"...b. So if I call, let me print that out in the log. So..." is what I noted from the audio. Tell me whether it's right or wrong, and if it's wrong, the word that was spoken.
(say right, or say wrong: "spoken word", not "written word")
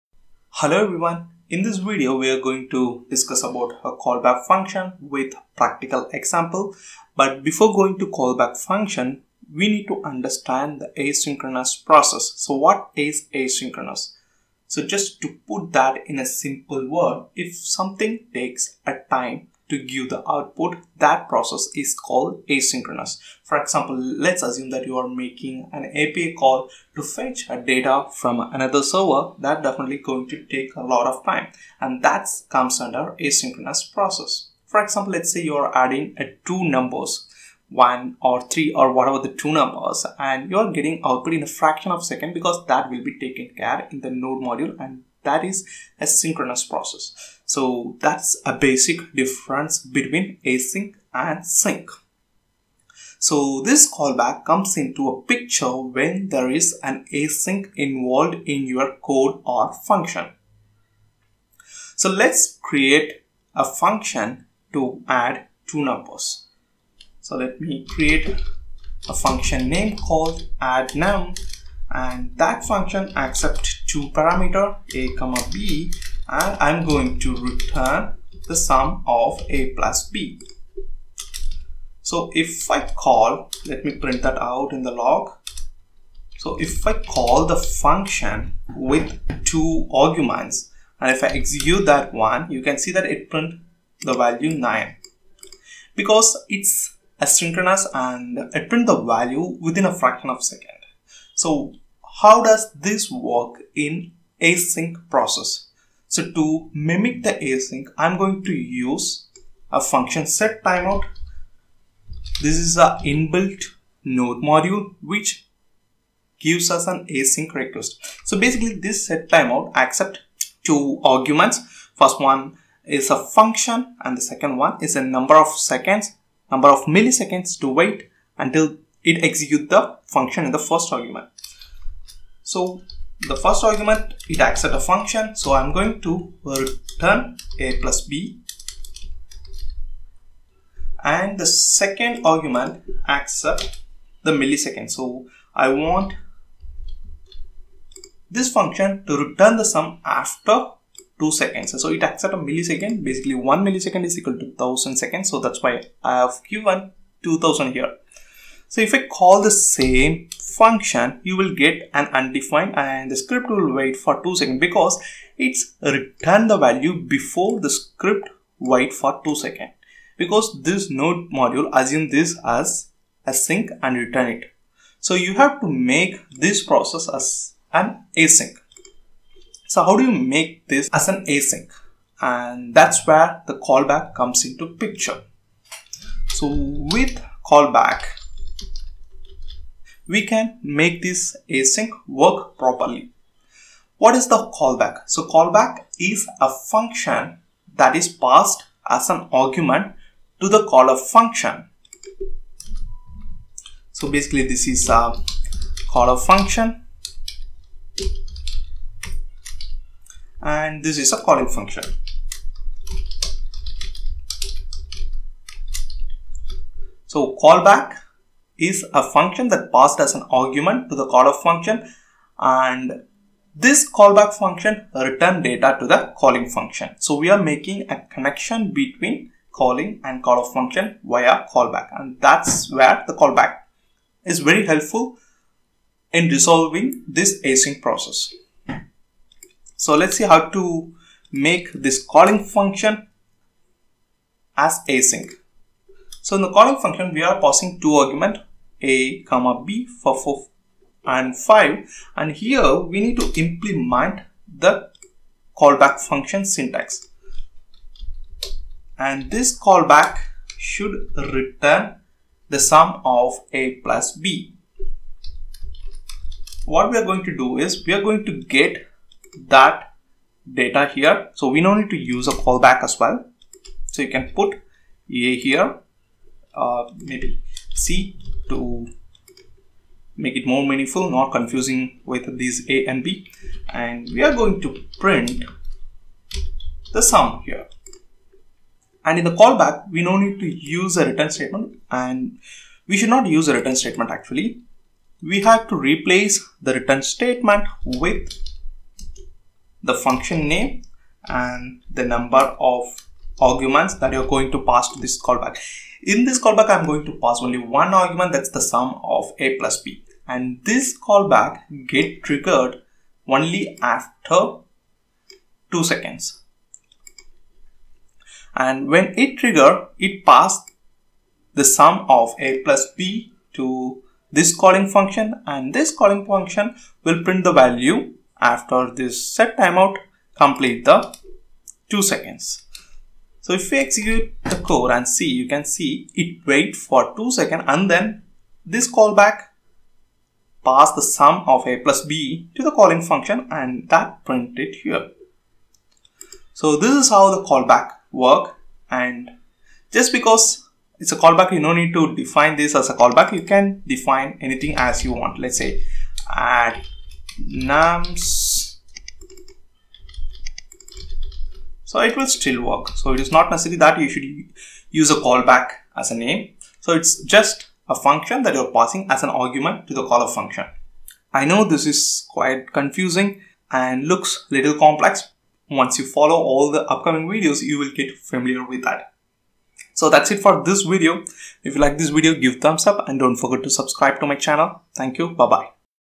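right.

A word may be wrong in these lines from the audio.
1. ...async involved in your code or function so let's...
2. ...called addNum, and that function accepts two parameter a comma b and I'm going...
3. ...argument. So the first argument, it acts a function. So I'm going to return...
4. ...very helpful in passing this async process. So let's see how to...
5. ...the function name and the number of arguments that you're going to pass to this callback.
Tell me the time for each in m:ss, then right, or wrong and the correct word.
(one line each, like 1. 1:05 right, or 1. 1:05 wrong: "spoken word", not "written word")
1. 0:57 right
2. 1:09 right
3. 2:10 right
4. 3:54 wrong: "resolving", not "passing"
5. 4:59 right.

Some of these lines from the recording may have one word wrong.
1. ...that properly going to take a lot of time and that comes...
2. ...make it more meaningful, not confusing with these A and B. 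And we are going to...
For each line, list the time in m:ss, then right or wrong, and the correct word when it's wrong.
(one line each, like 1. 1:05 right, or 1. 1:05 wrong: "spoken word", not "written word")
1. 0:29 wrong: "definitely", not "properly"
2. 4:40 right.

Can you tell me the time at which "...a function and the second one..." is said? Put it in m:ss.
2:03.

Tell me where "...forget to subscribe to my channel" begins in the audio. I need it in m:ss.
6:23.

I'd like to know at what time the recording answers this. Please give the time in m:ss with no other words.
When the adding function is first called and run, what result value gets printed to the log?
1:34.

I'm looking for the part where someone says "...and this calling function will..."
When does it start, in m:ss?
5:25.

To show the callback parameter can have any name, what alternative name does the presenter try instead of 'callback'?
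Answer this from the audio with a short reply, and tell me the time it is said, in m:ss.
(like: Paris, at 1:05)
add nums, at 5:56.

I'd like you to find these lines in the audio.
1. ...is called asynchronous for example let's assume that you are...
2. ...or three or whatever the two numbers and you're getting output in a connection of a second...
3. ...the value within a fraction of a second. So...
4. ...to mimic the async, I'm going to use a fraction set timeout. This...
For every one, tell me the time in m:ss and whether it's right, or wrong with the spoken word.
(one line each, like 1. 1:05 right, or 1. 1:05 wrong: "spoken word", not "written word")
1. 0:21 right
2. 0:38 wrong: "fraction", not "connection"
3. 1:38 right
4. 1:46 wrong: "function", not "fraction".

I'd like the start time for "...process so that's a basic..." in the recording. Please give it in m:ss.
0:46.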